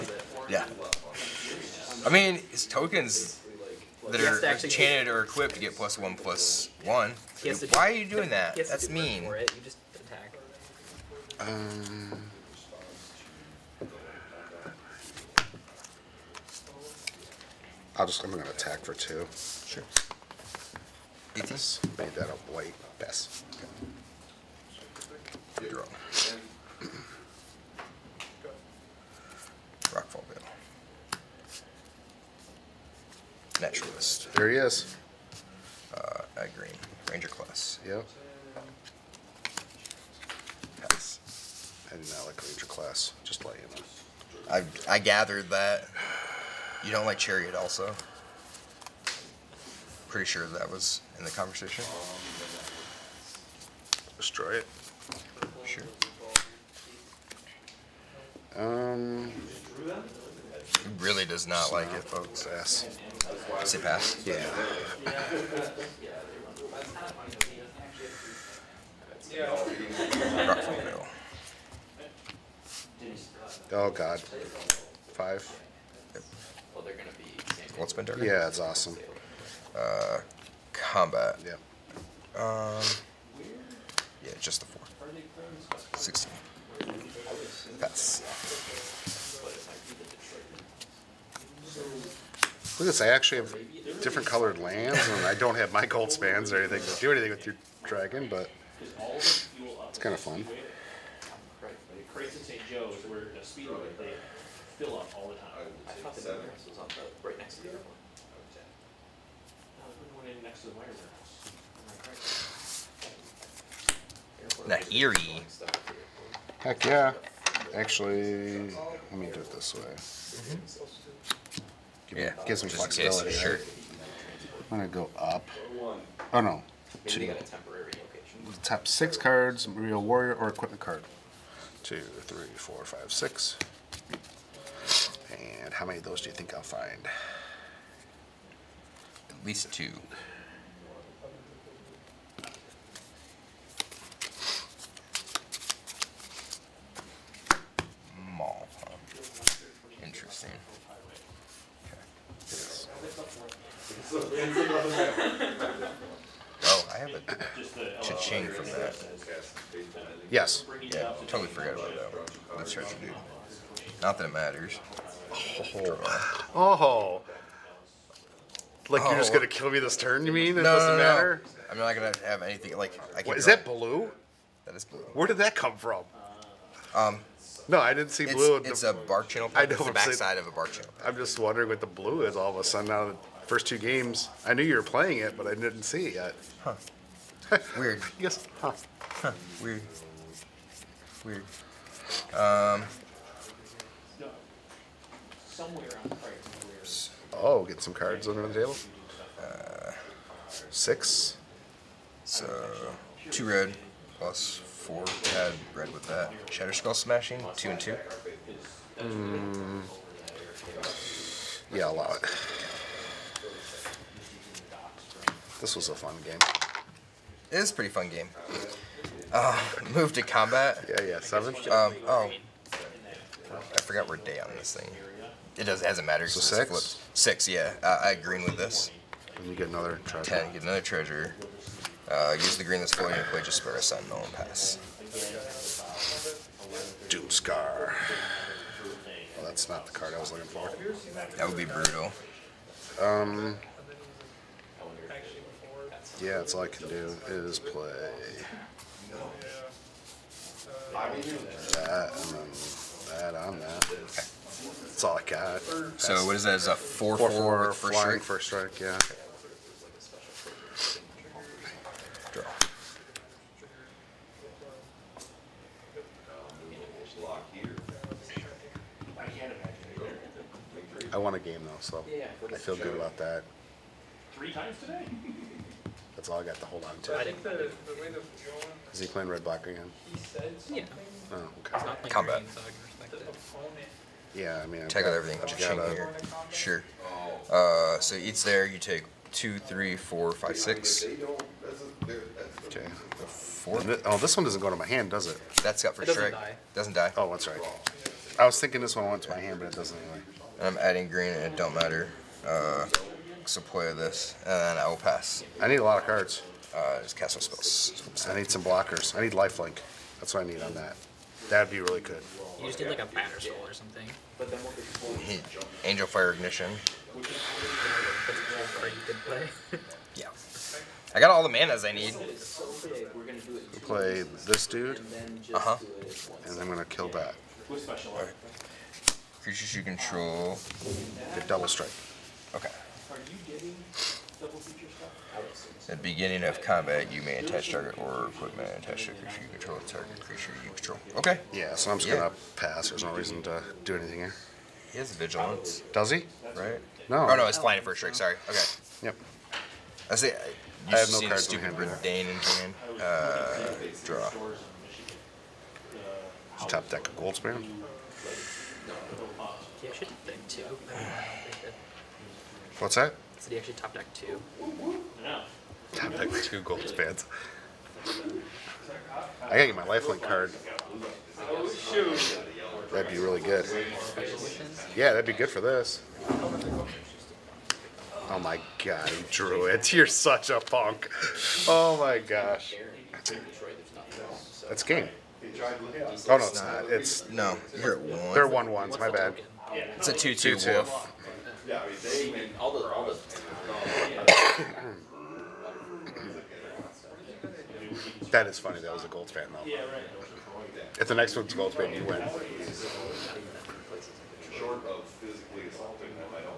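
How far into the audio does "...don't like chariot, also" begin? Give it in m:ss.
0:46.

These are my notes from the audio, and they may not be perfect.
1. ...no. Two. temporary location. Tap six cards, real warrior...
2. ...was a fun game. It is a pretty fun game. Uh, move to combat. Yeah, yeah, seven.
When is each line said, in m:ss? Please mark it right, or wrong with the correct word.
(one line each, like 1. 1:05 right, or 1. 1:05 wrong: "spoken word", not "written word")
1. 2:06 right
2. 3:35 right.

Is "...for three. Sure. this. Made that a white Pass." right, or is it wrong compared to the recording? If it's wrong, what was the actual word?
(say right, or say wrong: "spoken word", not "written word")
wrong: "two", not "three".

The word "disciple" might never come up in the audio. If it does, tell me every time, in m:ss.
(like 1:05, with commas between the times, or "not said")
not said.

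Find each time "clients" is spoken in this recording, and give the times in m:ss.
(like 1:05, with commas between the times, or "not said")
not said.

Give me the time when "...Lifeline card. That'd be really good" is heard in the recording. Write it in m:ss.
6:09.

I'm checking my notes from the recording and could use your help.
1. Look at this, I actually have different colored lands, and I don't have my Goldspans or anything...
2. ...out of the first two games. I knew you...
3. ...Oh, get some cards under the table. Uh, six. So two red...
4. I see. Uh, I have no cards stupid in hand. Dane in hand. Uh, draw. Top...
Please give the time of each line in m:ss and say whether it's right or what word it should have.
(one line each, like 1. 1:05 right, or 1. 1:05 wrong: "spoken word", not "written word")
1. 1:31 right
2. 3:02 right
3. 3:17 right
4. 5:50 right.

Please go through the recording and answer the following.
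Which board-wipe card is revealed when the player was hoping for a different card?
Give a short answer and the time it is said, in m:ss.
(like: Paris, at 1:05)
Doomskar, at 3:57.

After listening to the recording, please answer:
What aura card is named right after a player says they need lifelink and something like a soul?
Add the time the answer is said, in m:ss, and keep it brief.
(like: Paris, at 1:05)
Angelfire Ignition, at 5:15.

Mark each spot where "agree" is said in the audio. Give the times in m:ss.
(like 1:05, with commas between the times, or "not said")
3:48.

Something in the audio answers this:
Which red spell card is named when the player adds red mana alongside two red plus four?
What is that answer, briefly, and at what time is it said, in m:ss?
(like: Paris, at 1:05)
Shatterskull Smashing, at 3:26.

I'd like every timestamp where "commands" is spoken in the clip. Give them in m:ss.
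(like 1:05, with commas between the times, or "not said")
not said.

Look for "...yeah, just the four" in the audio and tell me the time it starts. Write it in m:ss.
1:24.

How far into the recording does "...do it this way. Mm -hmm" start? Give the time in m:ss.
1:59.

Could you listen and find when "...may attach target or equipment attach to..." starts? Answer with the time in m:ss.
5:37.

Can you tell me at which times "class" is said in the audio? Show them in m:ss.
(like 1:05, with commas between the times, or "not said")
0:37, 0:42.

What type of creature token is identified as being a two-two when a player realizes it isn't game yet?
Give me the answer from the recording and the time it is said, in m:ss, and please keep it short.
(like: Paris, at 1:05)
wolf, at 6:30.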